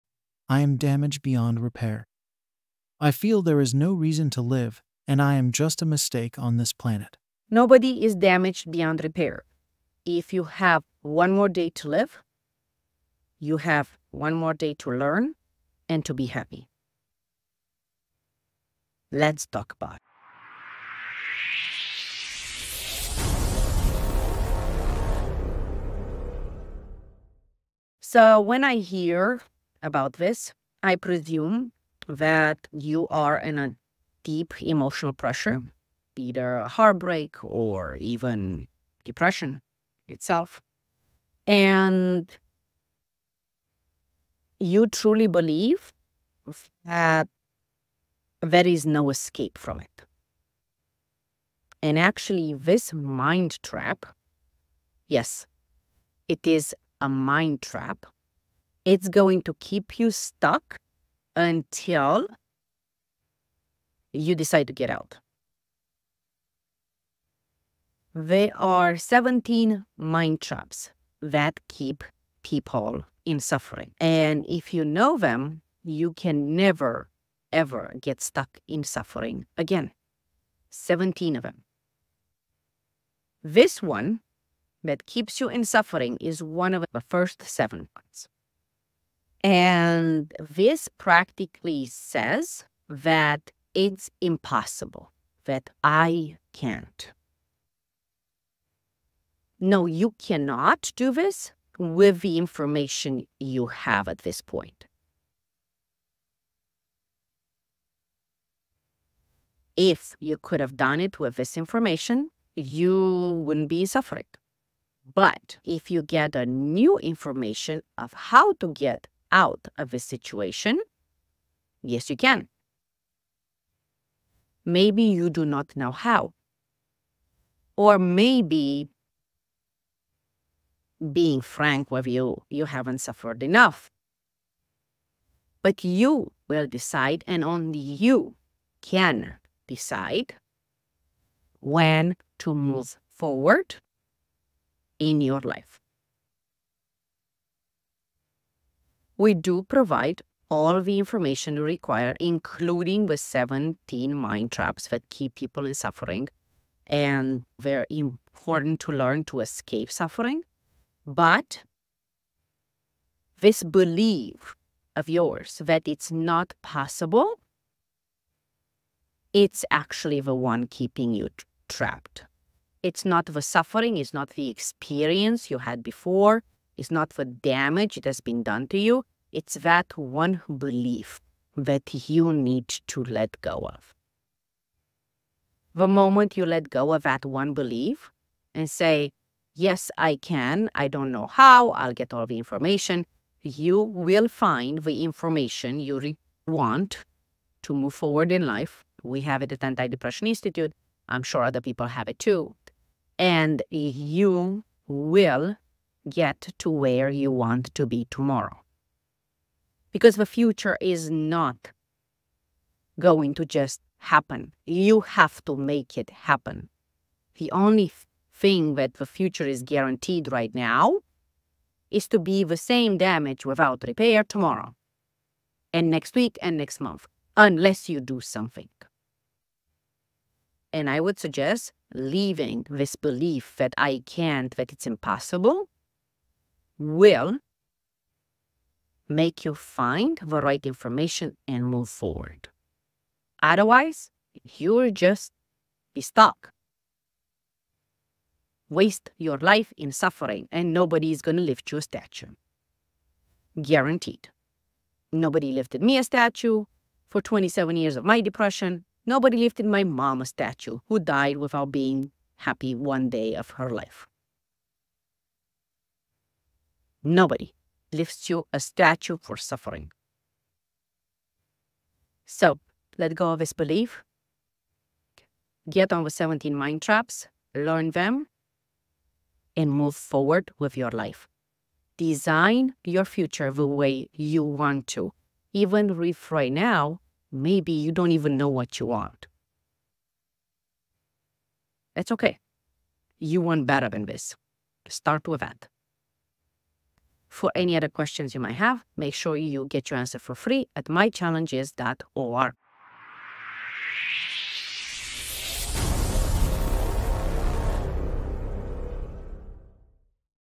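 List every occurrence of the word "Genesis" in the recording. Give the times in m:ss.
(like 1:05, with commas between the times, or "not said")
not said.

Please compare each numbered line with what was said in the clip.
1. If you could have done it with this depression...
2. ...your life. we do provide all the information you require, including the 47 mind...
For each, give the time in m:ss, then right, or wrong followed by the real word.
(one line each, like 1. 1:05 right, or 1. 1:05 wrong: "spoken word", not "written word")
1. 1:49 wrong: "information", not "depression"
2. 2:25 wrong: "17", not "47".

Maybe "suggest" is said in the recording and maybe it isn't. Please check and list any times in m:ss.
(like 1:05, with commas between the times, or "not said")
3:51.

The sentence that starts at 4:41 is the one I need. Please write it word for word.
Design your future the way you want to.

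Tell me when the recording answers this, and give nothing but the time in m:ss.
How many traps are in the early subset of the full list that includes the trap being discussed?
1:27.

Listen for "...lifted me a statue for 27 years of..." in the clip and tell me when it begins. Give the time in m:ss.
4:15.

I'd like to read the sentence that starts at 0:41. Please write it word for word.
And you truly believe that there is no escape from it.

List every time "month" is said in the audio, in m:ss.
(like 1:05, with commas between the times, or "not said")
3:46.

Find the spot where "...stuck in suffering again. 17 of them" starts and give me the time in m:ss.
1:18.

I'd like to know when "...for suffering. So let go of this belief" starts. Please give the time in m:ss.
4:29.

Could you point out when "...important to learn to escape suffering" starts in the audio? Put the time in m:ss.
2:37.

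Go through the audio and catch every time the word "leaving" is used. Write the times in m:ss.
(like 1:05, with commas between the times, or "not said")
3:51.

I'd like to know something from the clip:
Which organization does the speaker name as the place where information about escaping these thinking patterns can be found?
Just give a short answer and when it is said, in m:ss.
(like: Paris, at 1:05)
Anti Depression Institute, at 3:19.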